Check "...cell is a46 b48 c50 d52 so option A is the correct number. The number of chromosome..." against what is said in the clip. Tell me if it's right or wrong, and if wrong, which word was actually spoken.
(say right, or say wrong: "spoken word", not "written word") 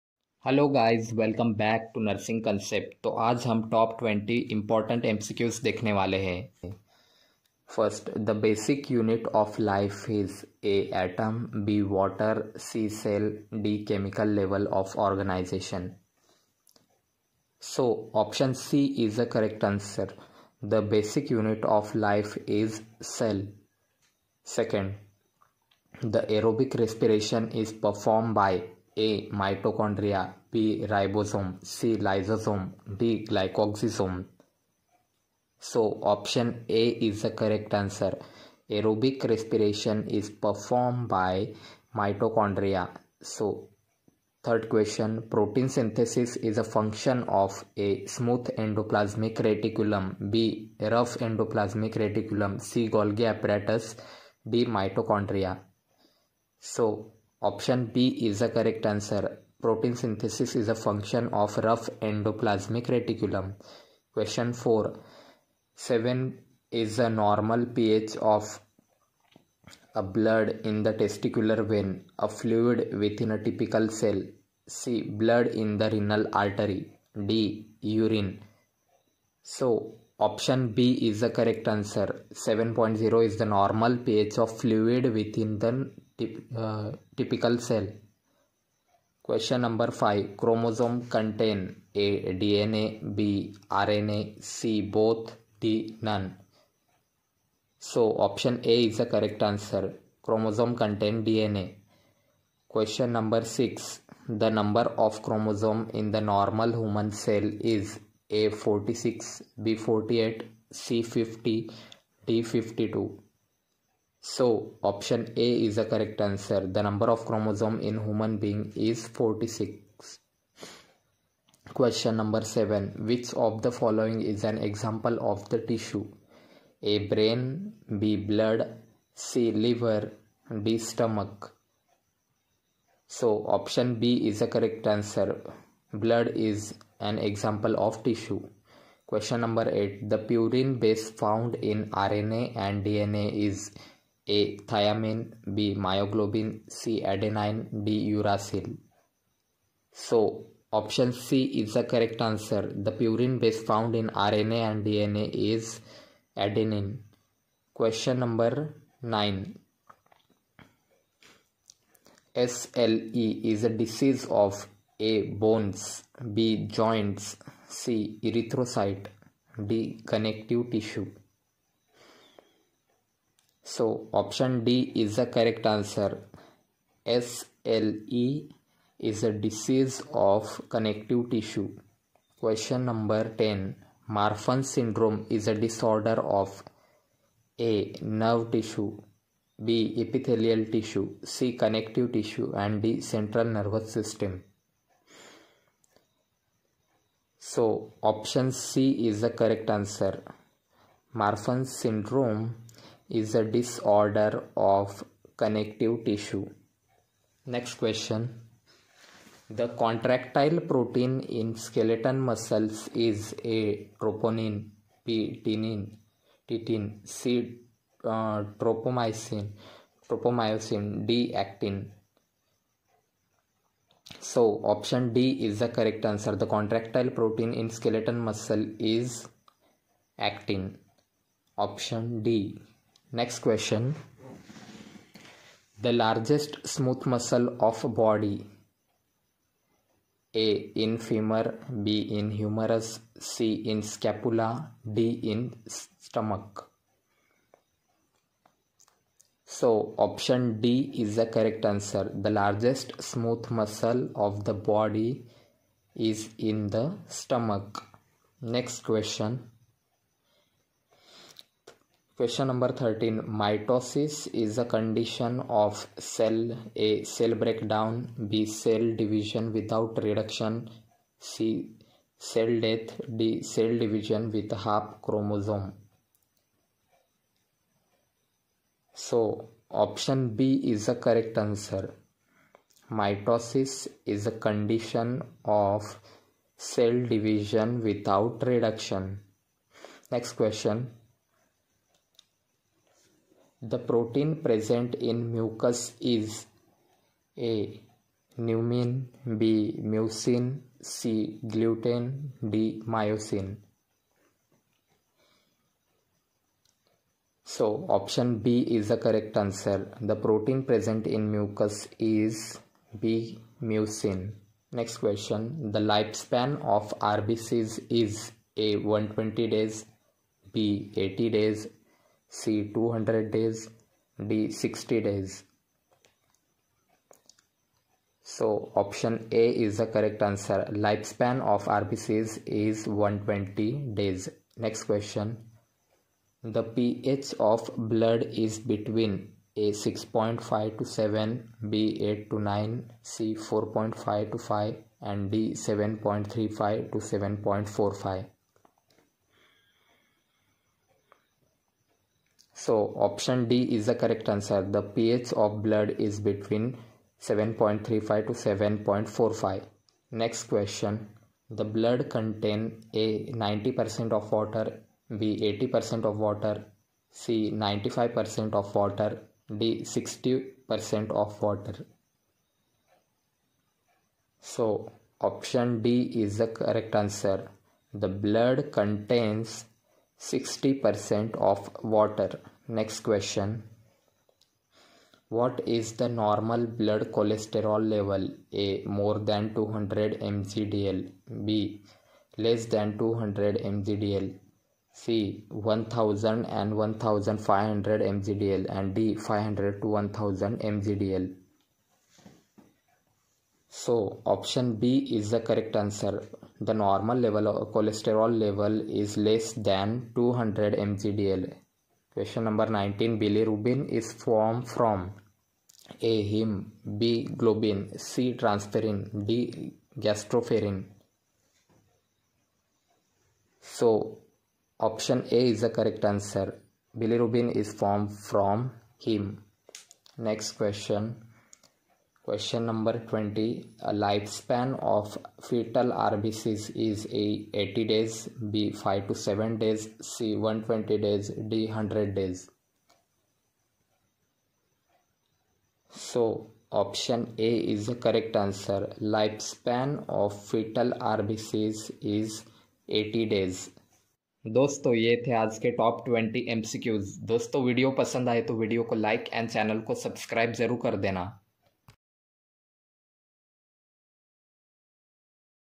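wrong: "answer", not "number".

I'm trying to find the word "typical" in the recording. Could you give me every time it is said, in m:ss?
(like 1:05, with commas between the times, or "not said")
1:13, 1:27.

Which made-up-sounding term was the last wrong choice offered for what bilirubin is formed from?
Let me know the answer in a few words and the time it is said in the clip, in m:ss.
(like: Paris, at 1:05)
Gastroferrin, at 6:59.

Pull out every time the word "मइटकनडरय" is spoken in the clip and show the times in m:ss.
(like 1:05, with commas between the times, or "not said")
0:29, 0:41, 0:54.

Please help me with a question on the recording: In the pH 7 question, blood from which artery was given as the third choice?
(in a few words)
renal artery.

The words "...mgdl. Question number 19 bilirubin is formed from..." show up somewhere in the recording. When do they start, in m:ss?
6:50.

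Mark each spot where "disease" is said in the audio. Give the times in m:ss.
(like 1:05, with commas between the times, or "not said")
2:43, 2:59.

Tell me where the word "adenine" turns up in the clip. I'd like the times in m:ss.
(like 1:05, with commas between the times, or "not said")
2:27, 2:36.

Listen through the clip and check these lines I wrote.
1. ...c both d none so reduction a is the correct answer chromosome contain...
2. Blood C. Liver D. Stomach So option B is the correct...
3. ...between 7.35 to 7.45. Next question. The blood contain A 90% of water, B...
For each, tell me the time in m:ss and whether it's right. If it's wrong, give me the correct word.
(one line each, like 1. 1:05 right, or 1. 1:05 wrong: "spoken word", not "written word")
1. 1:34 wrong: "option", not "reduction"
2. 2:08 right
3. 5:56 right.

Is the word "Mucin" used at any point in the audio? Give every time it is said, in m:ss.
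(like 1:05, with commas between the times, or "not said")
4:59, 5:13.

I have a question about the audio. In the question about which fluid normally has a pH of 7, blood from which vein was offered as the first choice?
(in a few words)
testicular vein.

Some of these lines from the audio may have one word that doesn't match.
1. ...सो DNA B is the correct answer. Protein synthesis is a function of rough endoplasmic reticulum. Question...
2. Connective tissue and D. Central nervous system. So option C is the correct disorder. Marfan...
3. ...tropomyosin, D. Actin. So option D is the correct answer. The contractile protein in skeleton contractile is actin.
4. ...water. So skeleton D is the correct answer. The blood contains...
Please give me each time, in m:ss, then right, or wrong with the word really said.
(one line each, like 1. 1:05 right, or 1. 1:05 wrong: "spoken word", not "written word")
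1. 0:56 wrong: "Option", not "DNA"
2. 3:11 wrong: "answer", not "disorder"
3. 3:40 wrong: "muscle", not "contractile"
4. 6:11 wrong: "option", not "skeleton".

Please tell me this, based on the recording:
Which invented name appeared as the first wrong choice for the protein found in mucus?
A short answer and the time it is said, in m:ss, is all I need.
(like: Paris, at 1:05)
Numin, at 4:58.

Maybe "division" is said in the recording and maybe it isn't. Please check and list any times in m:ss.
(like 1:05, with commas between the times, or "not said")
4:28, 4:33, 4:46.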